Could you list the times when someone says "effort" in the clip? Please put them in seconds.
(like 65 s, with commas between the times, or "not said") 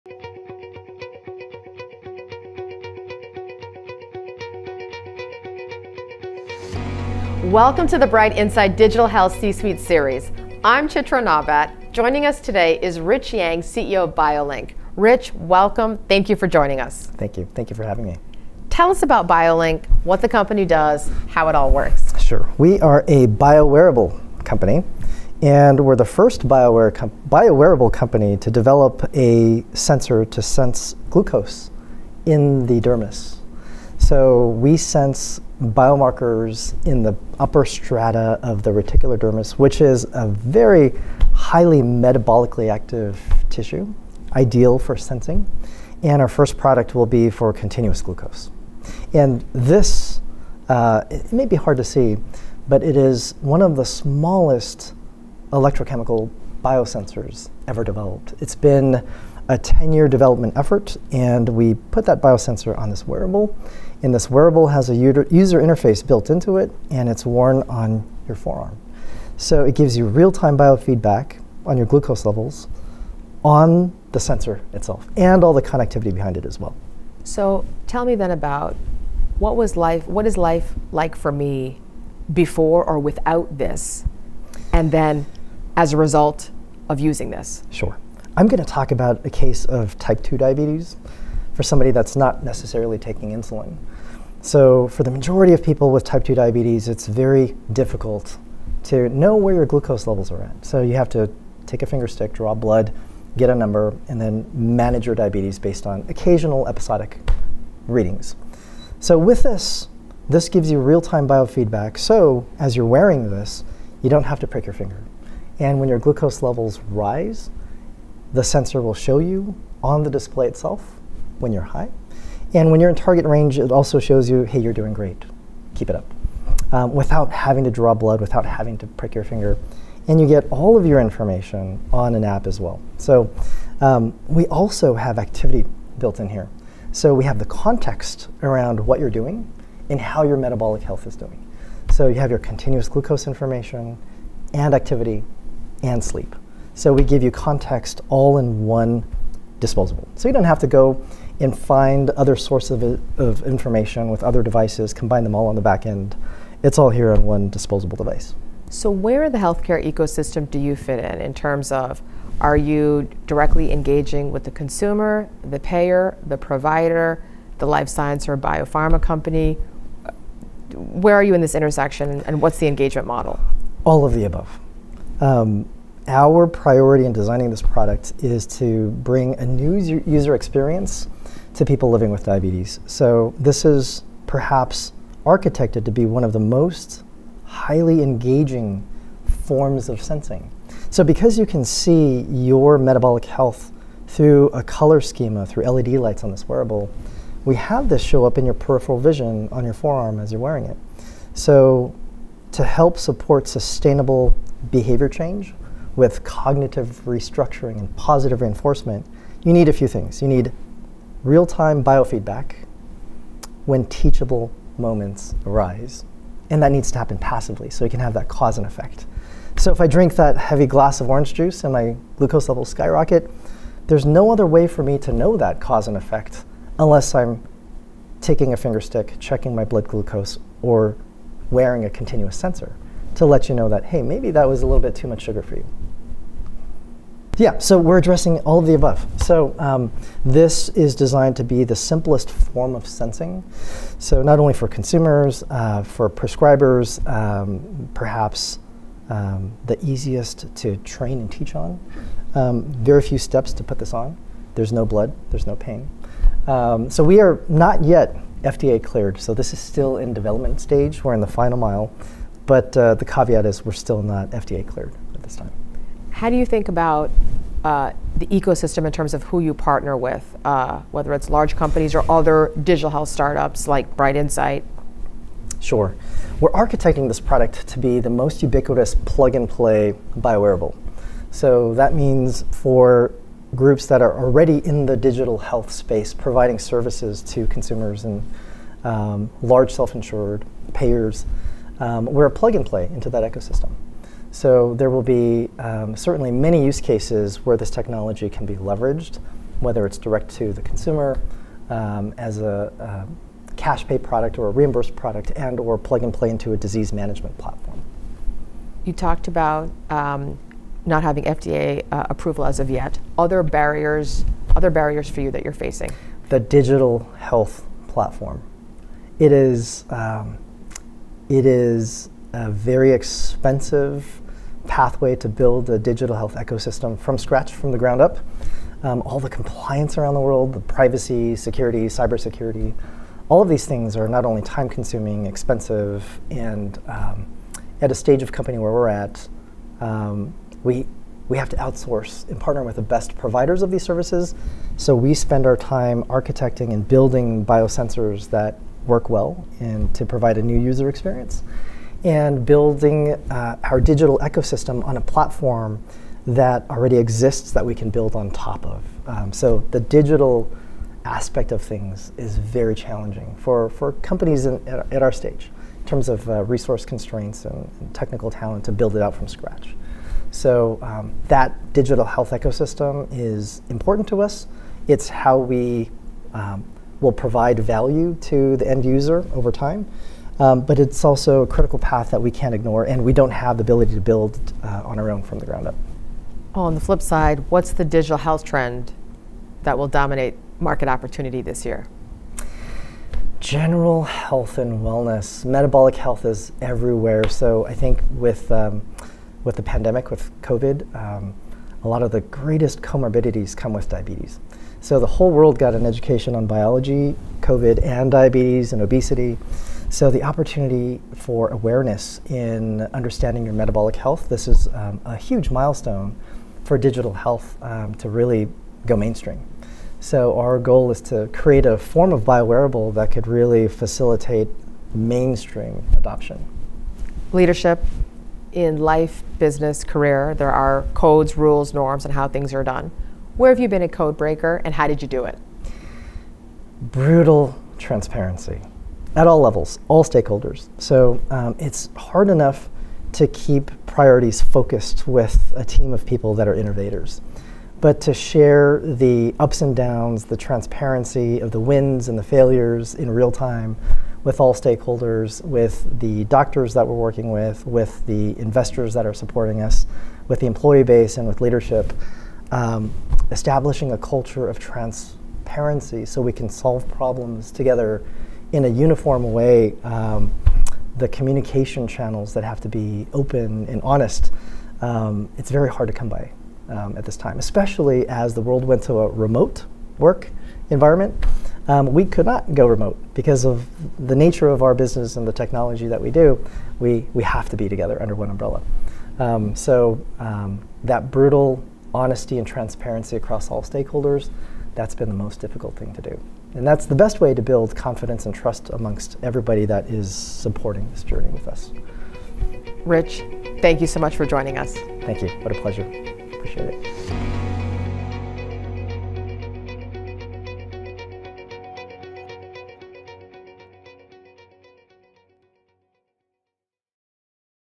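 60 s.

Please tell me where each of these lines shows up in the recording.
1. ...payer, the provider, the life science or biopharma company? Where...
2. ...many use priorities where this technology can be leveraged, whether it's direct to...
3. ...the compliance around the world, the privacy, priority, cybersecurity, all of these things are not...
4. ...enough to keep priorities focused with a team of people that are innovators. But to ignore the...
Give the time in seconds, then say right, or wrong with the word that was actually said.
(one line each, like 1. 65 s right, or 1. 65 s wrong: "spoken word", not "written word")
1. 165 s right
2. 296 s wrong: "cases", not "priorities"
3. 329 s wrong: "security", not "priority"
4. 442 s wrong: "share", not "ignore".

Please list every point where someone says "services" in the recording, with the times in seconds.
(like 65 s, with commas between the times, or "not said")
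286 s, 343 s.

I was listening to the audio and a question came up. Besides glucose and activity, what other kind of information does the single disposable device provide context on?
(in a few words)
Sleep.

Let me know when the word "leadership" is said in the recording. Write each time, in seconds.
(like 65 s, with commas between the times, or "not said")
427 s, 461 s.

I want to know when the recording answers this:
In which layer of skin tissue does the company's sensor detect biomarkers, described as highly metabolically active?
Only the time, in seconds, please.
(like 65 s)
38 s.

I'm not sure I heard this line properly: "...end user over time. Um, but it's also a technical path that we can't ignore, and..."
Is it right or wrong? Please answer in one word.
wrong.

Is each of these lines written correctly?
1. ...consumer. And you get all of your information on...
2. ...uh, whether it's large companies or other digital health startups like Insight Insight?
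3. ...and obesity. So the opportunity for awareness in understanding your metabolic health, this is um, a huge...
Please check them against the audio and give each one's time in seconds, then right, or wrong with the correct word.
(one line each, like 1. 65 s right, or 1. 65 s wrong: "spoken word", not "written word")
1. 129 s wrong: "finger", not "consumer"
2. 270 s wrong: "Bright", not "Insight"
3. 408 s right.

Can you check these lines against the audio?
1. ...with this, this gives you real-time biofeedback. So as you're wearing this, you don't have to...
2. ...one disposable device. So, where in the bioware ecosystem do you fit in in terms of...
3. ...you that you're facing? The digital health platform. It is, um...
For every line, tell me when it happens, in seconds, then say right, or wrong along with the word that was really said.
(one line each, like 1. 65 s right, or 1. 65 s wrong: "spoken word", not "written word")
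1. 109 s right
2. 157 s wrong: "healthcare", not "bioware"
3. 315 s right.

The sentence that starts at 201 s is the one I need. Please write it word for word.
So to help support sustainable behavior change with cognitive restructuring and positive reinforcement, you need a few things.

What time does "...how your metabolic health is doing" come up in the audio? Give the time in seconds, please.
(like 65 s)
139 s.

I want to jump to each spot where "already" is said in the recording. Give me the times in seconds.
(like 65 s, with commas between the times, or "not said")
284 s, 356 s.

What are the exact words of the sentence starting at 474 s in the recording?
Um, it's very hard to come by um, at this time, especially as the world went to a remote work environment.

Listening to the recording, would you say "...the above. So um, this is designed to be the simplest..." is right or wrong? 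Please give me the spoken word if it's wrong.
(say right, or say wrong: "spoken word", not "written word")
right.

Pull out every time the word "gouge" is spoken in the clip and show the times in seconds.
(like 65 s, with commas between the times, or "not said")
not said.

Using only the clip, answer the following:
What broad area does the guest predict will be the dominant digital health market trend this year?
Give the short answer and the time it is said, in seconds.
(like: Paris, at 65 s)
General health and wellness, at 393 s.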